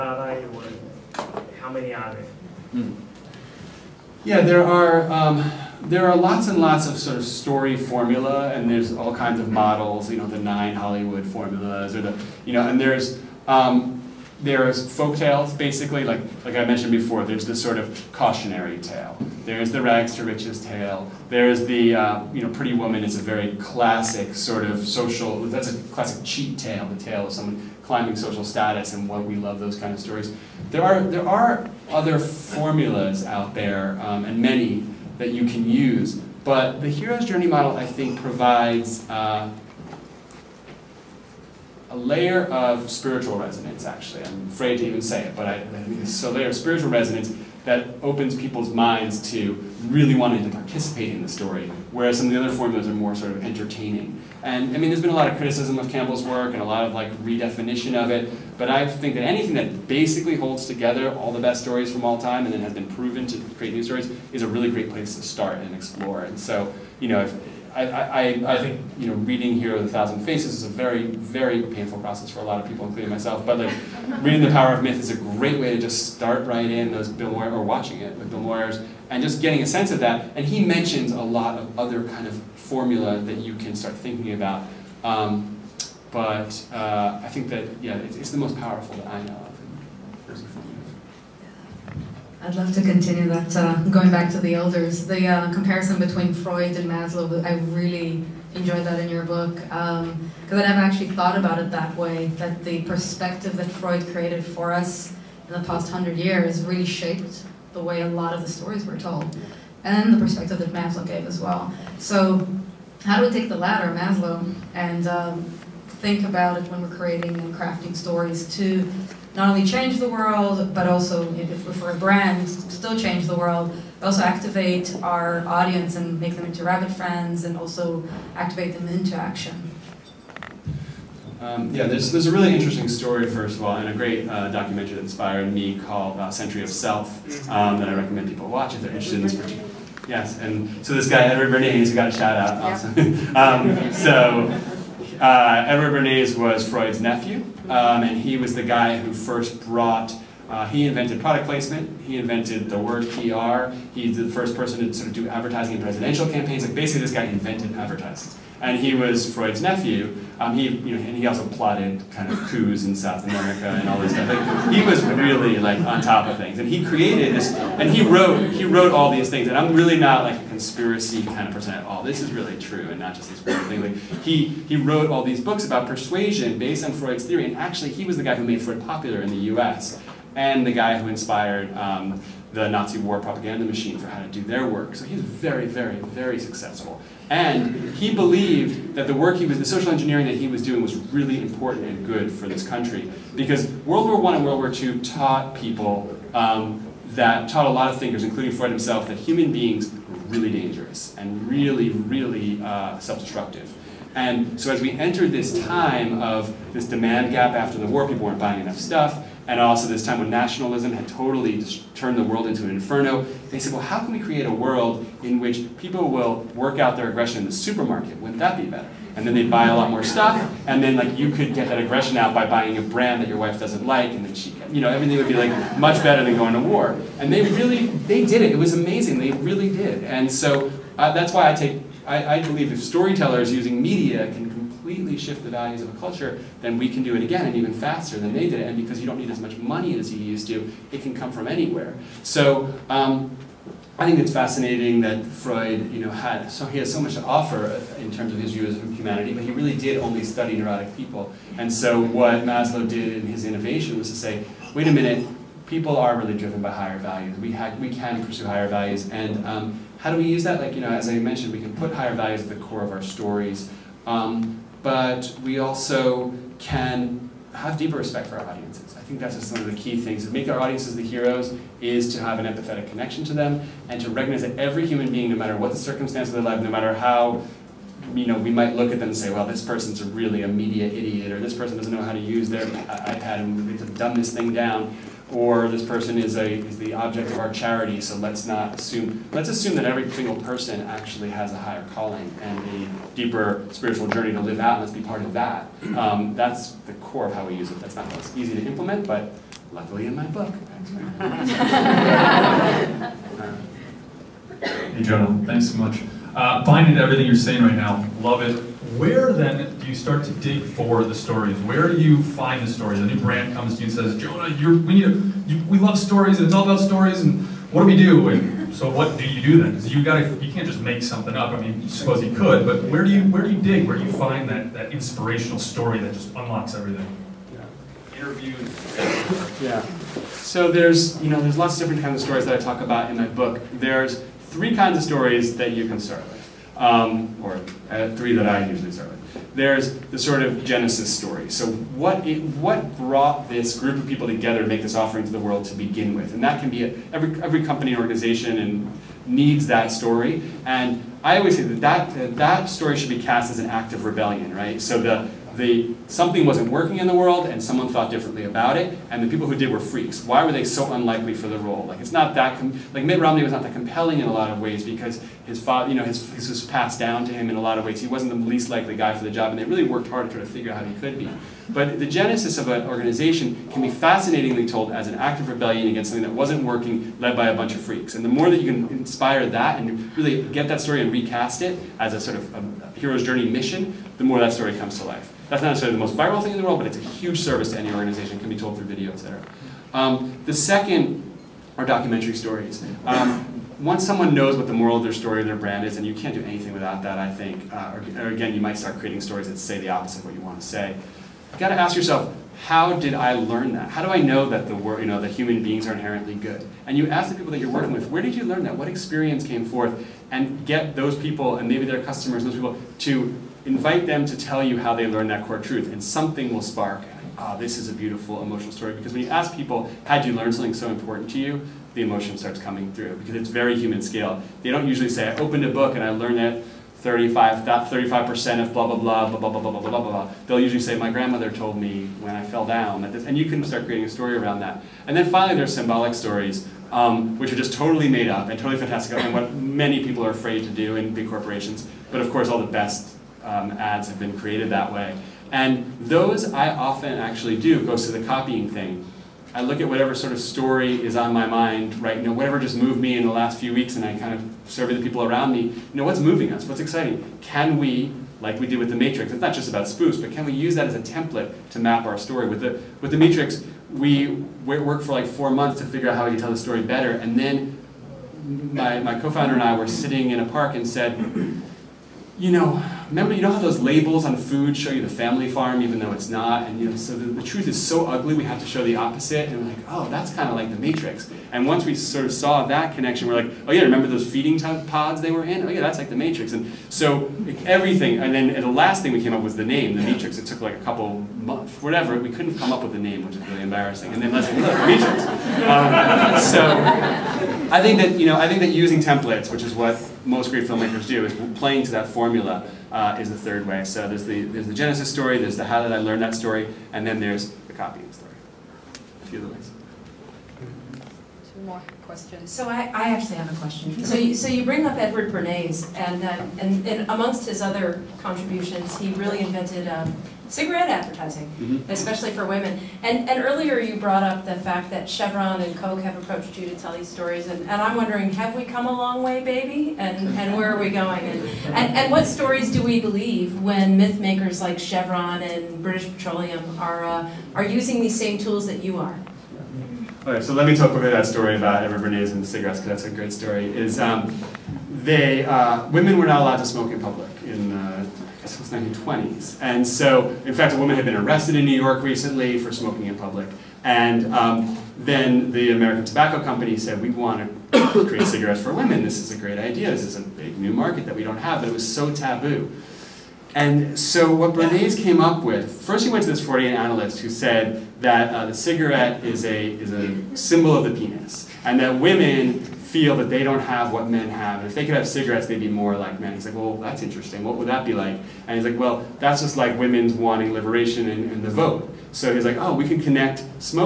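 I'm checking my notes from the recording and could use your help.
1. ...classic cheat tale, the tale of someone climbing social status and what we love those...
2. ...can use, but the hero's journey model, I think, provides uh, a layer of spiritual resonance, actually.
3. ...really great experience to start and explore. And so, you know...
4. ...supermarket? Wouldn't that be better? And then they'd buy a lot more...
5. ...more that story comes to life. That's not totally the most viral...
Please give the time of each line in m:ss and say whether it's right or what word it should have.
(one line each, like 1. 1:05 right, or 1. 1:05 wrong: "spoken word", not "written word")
1. 0:25 right
2. 0:35 right
3. 1:04 wrong: "place", not "experience"
4. 3:37 right
5. 6:24 wrong: "necessarily", not "totally".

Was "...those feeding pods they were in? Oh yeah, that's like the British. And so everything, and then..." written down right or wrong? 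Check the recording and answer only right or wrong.
wrong.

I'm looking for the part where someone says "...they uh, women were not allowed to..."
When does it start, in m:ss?
9:05.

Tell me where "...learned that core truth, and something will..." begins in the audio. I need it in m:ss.
6:55.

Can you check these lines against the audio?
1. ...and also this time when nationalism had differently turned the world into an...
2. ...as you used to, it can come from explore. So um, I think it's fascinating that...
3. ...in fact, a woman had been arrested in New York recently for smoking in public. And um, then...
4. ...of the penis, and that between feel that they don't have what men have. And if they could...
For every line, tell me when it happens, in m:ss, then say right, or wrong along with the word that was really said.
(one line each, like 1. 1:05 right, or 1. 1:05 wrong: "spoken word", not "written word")
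1. 3:29 wrong: "totally", not "differently"
2. 3:59 wrong: "anywhere", not "explore"
3. 9:10 right
4. 9:30 wrong: "women", not "between".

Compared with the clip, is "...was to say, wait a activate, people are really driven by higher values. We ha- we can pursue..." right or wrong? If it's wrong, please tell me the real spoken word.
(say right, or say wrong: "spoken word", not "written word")
wrong: "minute", not "activate".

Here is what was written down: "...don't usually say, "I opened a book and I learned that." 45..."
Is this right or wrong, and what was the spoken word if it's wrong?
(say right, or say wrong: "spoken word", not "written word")
wrong: "35", not "45".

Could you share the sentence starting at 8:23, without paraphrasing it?
So there's the, there's the Genesis story, there's the how did I learn that story, and then there's the copying story.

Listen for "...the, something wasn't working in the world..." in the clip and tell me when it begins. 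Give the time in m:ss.
5:55.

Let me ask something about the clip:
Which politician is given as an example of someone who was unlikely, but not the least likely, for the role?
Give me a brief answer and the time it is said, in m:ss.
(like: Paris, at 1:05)
Mitt Romney, at 6:03.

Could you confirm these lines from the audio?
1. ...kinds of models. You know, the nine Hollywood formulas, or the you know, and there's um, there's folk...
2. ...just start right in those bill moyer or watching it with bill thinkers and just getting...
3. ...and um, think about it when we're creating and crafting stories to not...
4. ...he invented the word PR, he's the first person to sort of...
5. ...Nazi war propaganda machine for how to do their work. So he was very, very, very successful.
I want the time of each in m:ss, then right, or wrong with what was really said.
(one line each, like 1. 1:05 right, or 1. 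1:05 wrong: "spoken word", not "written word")
1. 0:09 right
2. 1:15 wrong: "moyers", not "thinkers"
3. 1:54 right
4. 2:32 right
5. 3:02 right.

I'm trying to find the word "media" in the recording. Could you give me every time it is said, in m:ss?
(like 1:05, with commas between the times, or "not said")
3:53, 4:40.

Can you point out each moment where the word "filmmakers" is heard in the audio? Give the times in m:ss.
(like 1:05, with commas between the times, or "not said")
8:20.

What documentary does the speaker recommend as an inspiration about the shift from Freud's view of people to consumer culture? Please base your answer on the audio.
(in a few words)
Century of Self.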